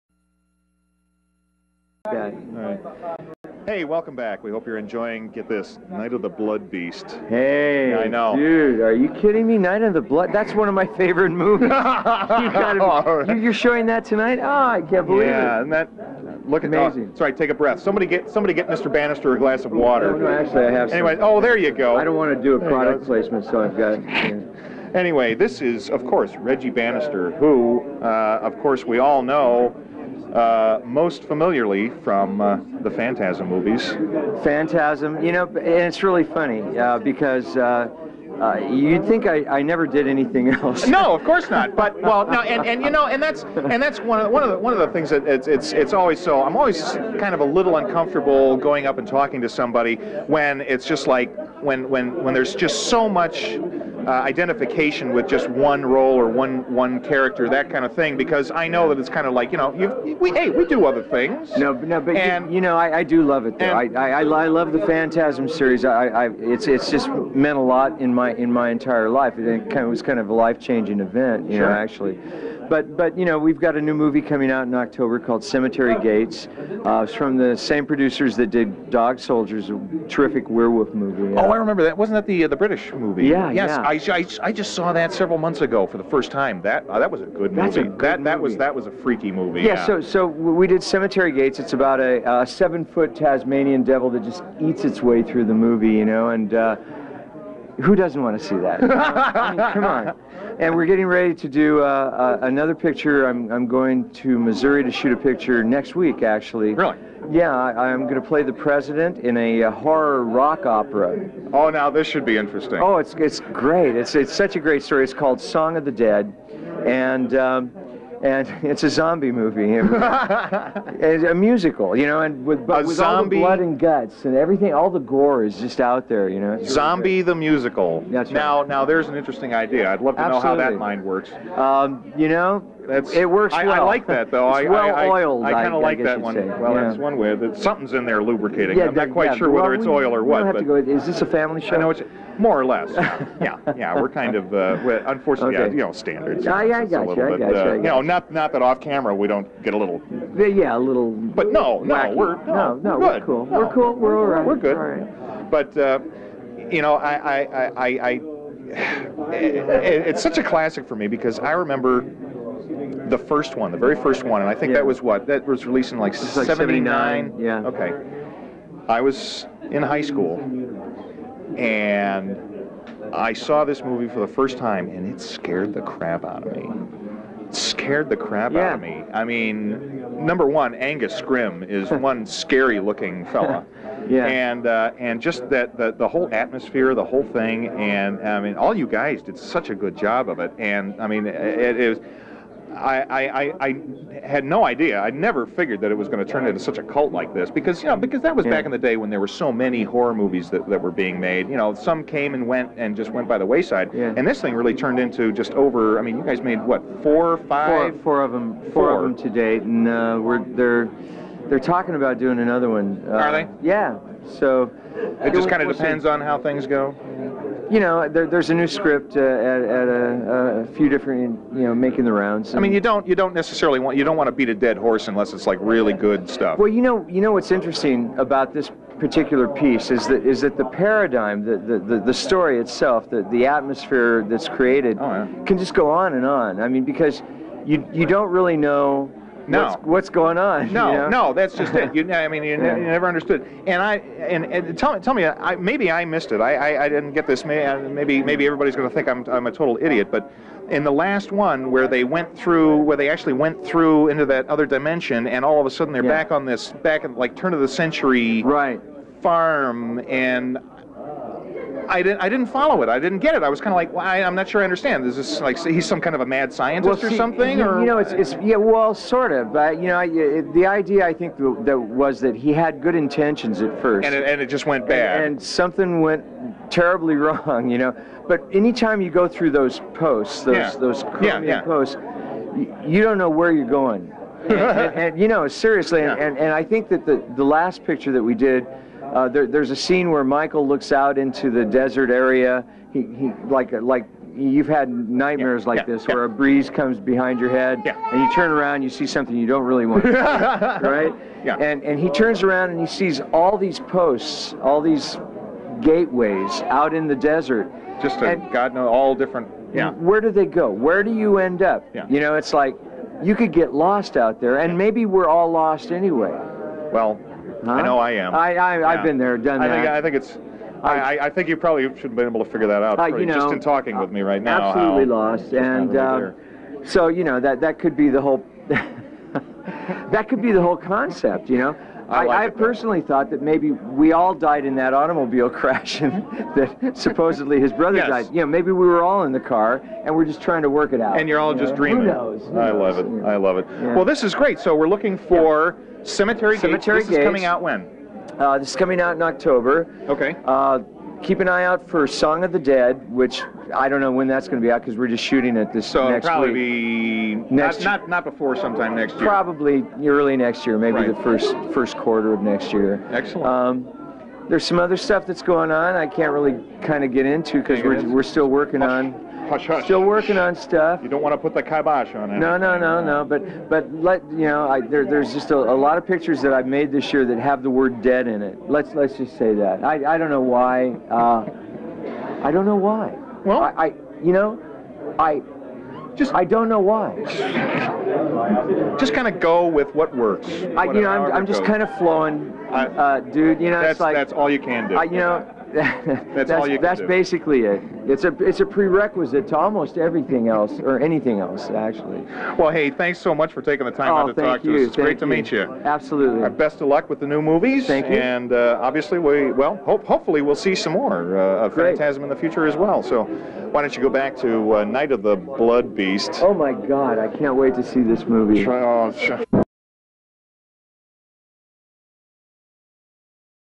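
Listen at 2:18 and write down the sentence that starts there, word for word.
Yeah, I'm not quite yeah, sure well, whether it's we, oil or what.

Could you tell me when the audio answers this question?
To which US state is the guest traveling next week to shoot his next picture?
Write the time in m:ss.
1:44.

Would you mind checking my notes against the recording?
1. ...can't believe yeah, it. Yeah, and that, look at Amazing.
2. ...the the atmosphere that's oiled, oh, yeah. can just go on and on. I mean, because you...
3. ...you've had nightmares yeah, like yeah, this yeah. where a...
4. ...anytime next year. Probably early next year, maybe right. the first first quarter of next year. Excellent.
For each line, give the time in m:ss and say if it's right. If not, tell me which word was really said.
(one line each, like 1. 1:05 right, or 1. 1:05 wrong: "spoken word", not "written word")
1. 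0:14 right
2. 3:53 wrong: "created", not "oiled"
3. 4:54 right
4. 5:58 wrong: "sometime", not "anytime".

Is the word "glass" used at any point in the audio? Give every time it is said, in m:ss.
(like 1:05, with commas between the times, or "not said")
0:19.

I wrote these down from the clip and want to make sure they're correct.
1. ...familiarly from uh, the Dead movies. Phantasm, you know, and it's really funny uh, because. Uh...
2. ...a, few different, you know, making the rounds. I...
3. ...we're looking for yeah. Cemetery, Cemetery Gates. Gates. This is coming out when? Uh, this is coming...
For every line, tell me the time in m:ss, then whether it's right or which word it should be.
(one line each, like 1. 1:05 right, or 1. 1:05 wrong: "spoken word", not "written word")
1. 0:31 wrong: "Phantasm", not "Dead"
2. 3:40 right
3. 5:44 right.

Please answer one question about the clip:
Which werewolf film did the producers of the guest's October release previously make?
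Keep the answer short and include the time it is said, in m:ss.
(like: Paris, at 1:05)
Dog Soldiers, at 1:18.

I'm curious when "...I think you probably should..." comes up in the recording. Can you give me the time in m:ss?
5:21.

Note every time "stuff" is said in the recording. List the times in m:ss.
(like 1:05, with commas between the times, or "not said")
3:46, 6:04, 6:10.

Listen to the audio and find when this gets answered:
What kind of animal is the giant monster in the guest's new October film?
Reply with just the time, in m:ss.
1:33.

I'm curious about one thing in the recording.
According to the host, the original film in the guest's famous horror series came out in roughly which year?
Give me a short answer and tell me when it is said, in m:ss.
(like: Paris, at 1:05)
1979, at 2:46.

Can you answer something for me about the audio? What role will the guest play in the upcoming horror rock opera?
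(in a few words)
the president.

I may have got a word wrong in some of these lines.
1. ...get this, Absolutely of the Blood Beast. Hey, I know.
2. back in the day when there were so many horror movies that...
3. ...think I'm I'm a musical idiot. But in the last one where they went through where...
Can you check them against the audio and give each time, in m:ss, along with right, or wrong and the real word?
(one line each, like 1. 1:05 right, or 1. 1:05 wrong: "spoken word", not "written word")
1. 0:05 wrong: "Night", not "Absolutely"
2. 3:18 right
3. 4:08 wrong: "total", not "musical".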